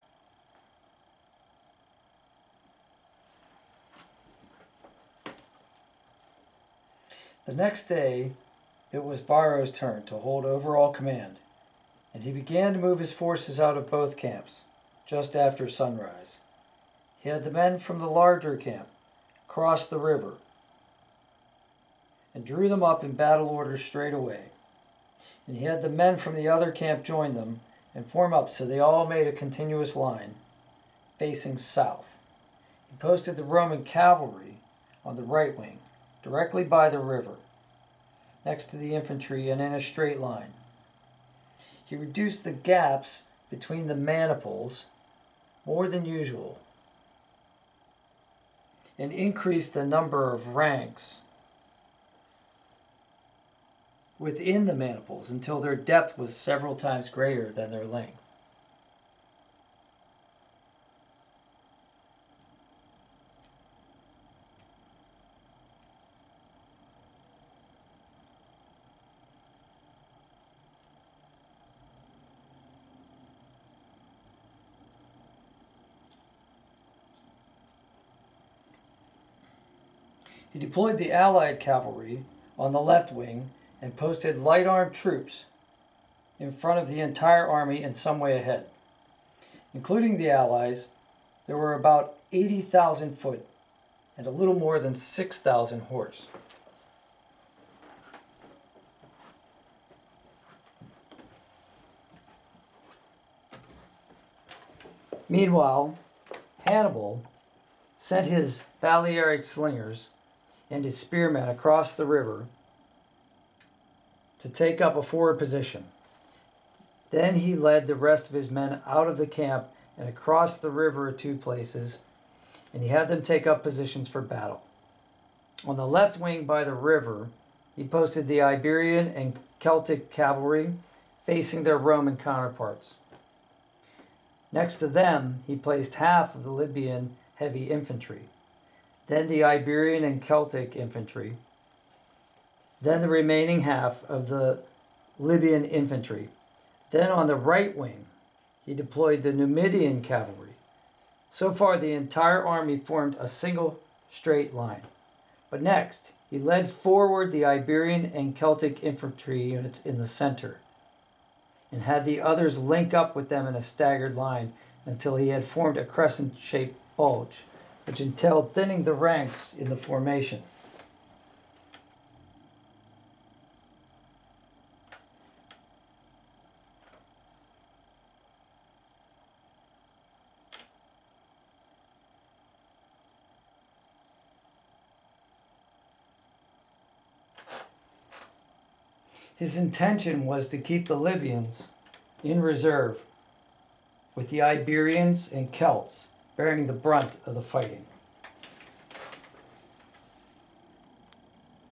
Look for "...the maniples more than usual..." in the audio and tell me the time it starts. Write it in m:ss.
0:43.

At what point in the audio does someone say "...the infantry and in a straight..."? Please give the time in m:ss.
0:38.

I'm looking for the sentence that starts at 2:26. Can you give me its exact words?
Then on the right wing, he deployed the Numidian cavalry.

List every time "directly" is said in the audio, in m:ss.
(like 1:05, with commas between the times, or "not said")
0:36.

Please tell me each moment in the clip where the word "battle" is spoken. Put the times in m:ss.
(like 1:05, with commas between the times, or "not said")
0:23, 2:04.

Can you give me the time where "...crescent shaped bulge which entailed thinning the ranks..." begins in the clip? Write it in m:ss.
2:45.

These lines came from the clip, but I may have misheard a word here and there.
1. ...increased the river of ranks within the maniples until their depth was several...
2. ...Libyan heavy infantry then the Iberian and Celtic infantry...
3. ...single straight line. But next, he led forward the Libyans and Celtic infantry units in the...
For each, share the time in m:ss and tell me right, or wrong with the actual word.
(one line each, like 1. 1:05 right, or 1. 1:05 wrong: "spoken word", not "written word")
1. 0:49 wrong: "number", not "river"
2. 2:16 right
3. 2:33 wrong: "Iberian", not "Libyans".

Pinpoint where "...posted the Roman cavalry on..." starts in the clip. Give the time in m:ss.
0:32.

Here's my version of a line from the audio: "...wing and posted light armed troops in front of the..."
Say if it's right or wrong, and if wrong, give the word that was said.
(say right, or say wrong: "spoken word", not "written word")
right.